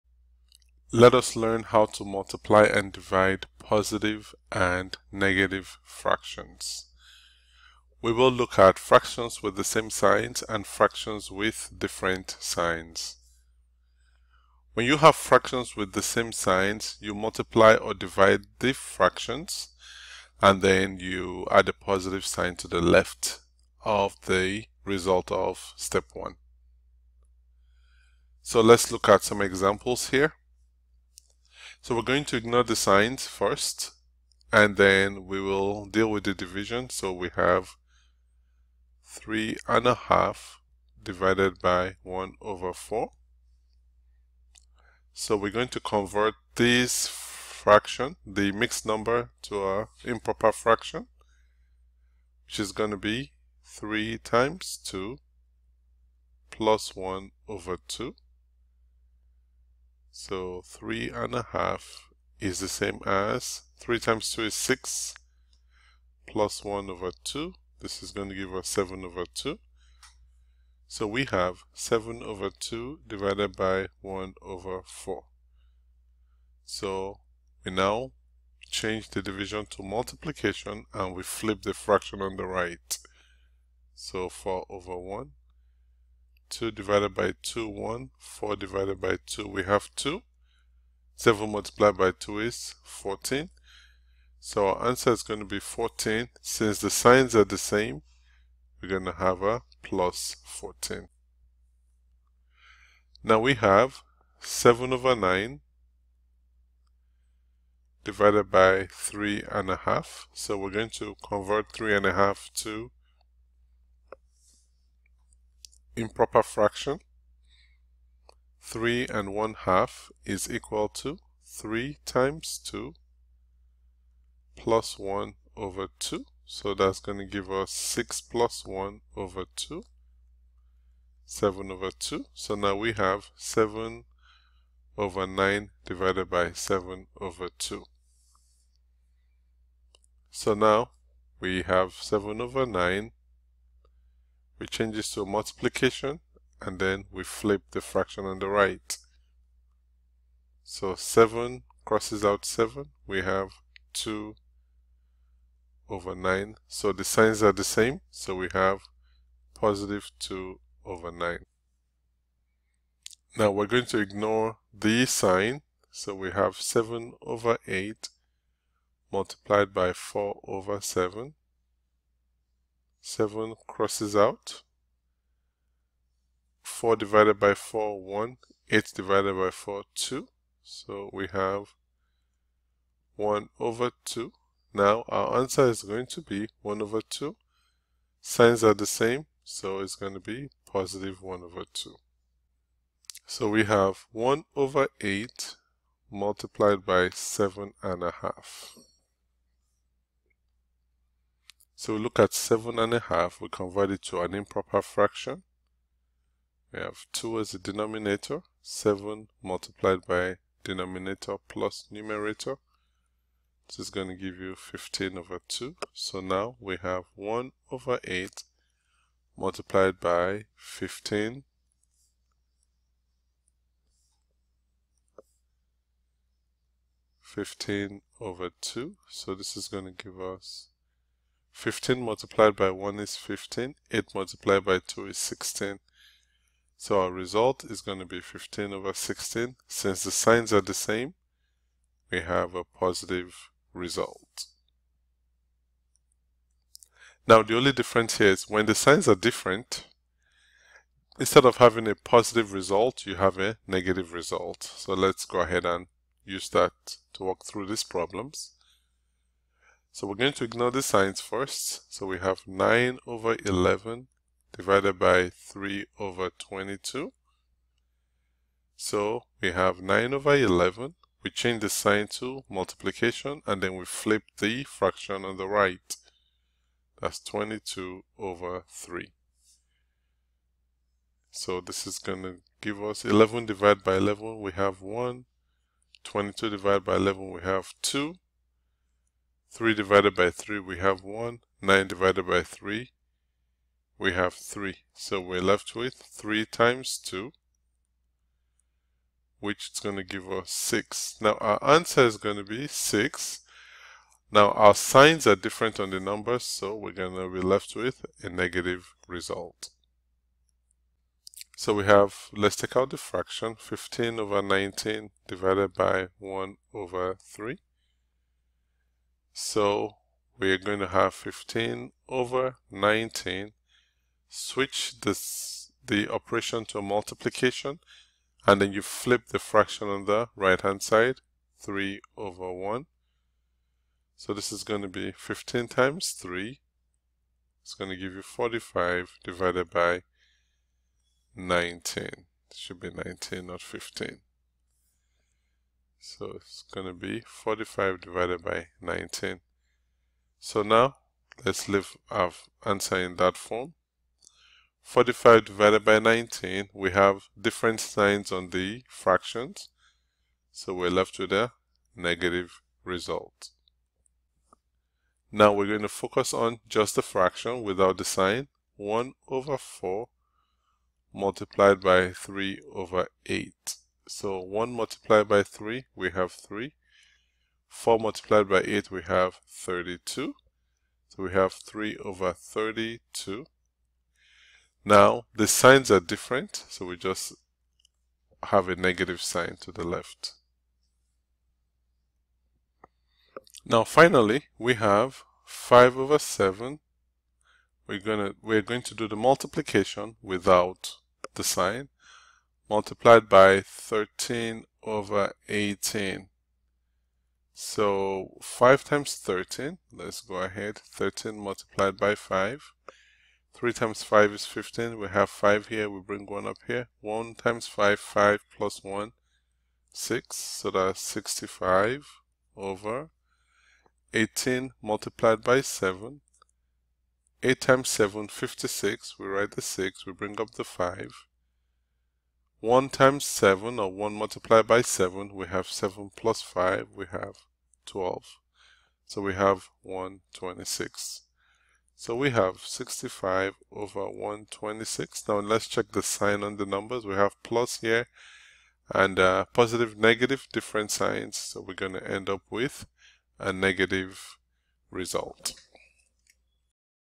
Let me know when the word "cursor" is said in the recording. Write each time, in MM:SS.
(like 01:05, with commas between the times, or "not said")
not said.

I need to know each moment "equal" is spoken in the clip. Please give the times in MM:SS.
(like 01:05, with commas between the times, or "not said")
02:00.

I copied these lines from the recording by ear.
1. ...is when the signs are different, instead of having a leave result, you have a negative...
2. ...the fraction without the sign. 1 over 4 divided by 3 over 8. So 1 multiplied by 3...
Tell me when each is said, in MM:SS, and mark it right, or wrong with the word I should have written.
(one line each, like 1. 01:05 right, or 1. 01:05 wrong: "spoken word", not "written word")
1. 04:08 wrong: "positive", not "leave"
2. 06:06 wrong: "multiplied", not "divided".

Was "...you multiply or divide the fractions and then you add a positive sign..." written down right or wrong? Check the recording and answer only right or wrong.
right.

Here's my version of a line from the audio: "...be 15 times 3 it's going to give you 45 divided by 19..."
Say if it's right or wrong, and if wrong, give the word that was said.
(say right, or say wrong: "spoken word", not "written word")
right.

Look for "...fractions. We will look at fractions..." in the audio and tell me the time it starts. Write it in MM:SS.
00:05.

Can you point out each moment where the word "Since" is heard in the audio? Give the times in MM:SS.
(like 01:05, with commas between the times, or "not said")
01:36, 03:59.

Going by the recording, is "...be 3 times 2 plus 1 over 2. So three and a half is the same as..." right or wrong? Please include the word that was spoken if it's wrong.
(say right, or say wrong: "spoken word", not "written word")
right.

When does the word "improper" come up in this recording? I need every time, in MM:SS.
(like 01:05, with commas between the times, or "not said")
00:50, 01:56, 03:24.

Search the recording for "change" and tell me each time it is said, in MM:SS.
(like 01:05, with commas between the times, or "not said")
01:18, 02:24, 04:31.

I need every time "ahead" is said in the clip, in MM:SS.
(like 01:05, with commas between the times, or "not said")
04:15, 06:50.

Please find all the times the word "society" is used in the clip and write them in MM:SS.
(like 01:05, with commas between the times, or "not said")
not said.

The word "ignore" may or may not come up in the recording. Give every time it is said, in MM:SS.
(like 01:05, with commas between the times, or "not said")
00:32, 02:43, 04:20.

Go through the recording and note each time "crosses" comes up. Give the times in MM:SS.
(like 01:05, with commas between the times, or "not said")
02:31, 02:53.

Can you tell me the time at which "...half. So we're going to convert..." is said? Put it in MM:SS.
01:49.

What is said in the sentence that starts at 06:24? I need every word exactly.
Now, the signs are different, so we just have a negative sign to the left.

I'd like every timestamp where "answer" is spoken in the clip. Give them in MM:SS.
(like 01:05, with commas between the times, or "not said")
01:34, 03:05, 05:01, 05:52.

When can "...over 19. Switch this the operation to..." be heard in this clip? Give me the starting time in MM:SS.
05:22.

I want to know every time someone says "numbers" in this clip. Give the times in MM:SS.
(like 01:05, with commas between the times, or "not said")
00:48, 05:05, 07:26.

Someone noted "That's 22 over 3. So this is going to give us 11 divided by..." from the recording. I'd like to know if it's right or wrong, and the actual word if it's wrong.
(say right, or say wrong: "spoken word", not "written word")
right.